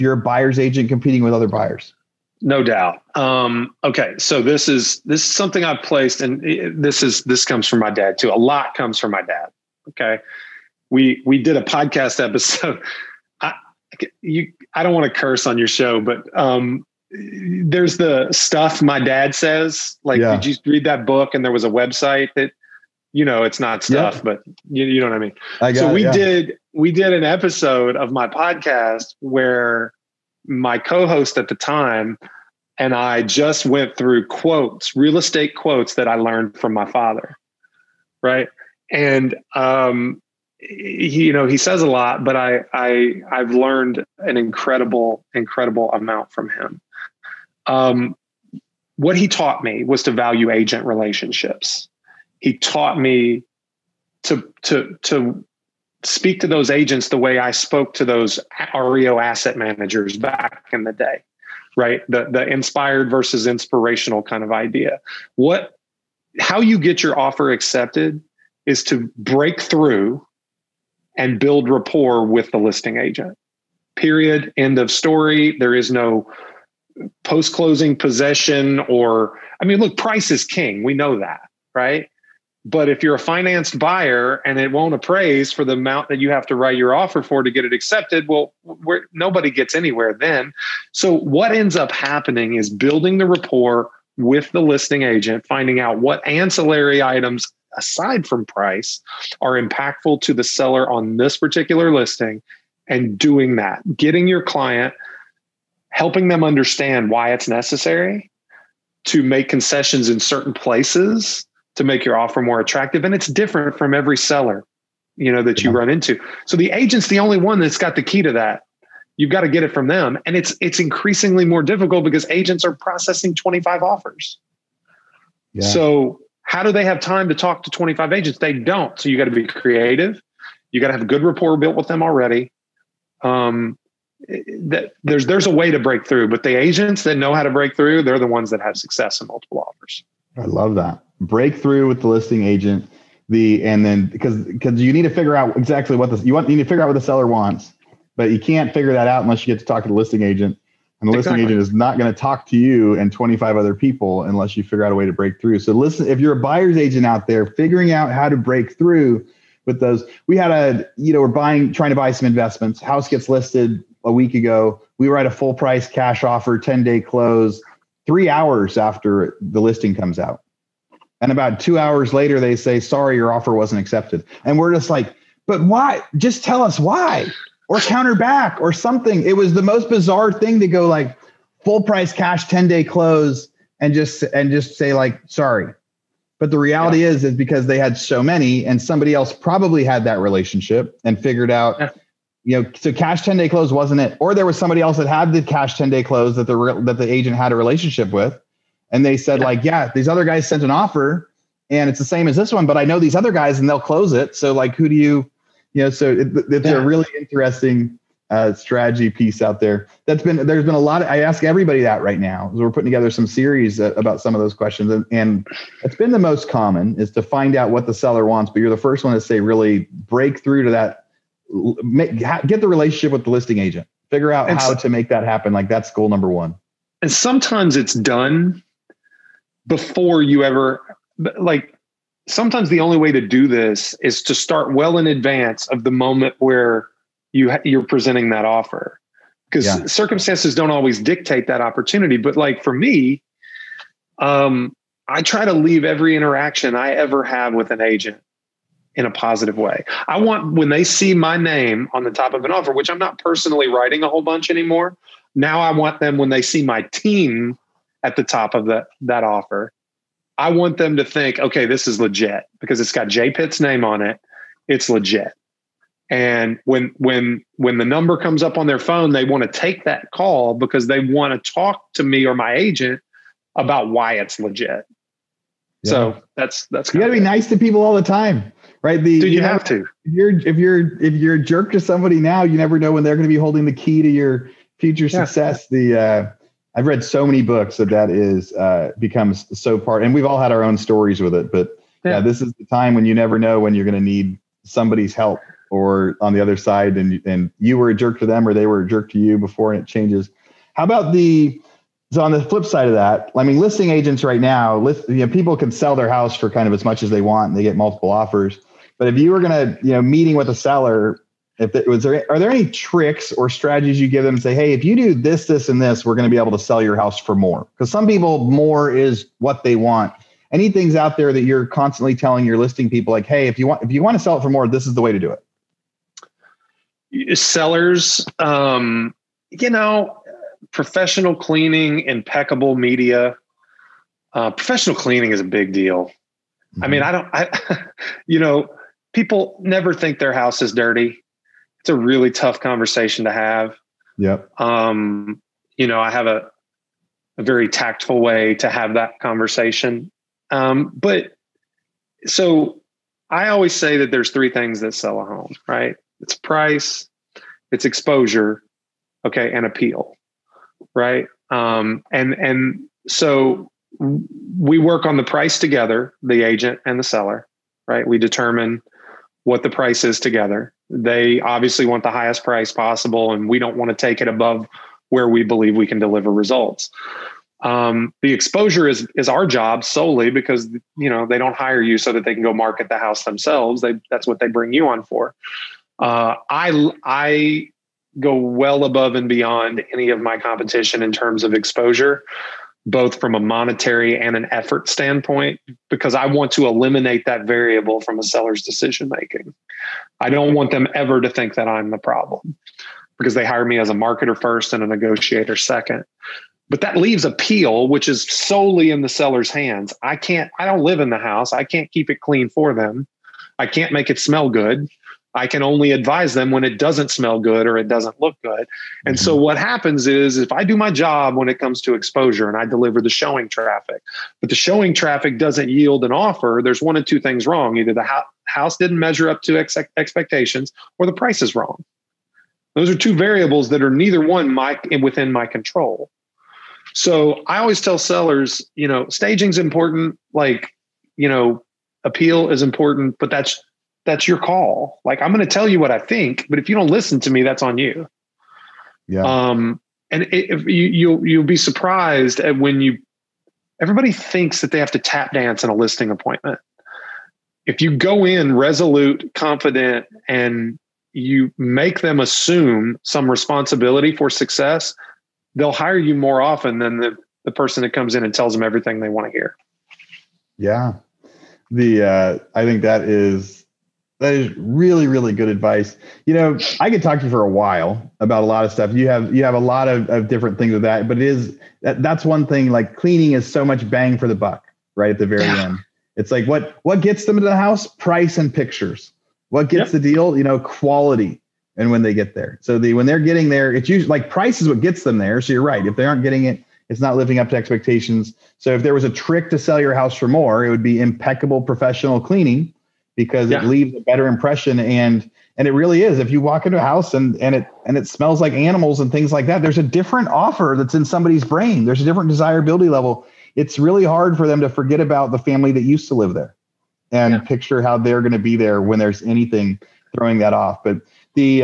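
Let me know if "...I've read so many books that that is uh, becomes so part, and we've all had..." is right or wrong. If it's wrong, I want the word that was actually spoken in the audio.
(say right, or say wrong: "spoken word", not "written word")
right.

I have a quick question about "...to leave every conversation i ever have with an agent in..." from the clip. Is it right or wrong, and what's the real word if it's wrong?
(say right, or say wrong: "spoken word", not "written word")
wrong: "interaction", not "conversation".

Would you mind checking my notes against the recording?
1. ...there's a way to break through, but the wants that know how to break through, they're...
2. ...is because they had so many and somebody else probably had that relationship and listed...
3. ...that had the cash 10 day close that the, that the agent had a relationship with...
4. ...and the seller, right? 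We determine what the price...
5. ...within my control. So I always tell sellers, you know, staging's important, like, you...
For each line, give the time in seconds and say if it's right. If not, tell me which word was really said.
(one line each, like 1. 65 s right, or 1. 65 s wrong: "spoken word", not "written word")
1. 135 s wrong: "agents", not "wants"
2. 187 s wrong: "figured", not "listed"
3. 194 s right
4. 366 s right
5. 435 s right.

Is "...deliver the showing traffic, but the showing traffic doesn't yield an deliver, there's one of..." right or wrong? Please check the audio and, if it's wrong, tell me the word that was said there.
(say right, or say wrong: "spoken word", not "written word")
wrong: "offer", not "deliver".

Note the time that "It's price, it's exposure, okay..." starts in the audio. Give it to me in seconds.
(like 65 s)
356 s.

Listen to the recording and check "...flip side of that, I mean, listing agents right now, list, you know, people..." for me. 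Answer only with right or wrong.
right.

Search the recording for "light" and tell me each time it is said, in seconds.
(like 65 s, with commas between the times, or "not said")
not said.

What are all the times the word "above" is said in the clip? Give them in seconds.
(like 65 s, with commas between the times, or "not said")
374 s, 388 s.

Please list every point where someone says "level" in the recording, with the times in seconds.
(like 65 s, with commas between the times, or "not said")
512 s.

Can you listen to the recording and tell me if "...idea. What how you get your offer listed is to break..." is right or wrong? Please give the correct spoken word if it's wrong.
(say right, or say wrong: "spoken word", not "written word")
wrong: "accepted", not "listed".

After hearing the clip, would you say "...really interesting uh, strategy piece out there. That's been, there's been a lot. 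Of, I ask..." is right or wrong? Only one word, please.
right.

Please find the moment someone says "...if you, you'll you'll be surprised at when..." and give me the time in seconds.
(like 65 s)
450 s.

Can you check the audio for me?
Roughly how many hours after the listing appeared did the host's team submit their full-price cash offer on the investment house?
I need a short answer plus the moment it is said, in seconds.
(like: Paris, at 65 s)
3, at 168 s.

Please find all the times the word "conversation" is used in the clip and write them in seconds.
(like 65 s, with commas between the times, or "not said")
342 s, 349 s.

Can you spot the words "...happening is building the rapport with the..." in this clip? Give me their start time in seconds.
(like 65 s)
91 s.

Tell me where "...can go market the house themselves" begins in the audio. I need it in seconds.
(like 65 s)
382 s.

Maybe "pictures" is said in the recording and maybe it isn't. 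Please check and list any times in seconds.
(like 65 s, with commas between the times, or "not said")
488 s, 517 s.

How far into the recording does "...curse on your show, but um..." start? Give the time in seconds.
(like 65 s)
15 s.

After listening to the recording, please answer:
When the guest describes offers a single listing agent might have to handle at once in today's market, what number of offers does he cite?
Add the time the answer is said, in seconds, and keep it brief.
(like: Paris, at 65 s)
25, at 123 s.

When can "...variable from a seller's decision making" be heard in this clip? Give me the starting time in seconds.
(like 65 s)
397 s.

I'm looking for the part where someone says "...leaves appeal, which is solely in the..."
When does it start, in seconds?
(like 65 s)
406 s.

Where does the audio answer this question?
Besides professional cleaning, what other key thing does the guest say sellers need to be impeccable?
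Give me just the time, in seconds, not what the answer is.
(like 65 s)
332 s.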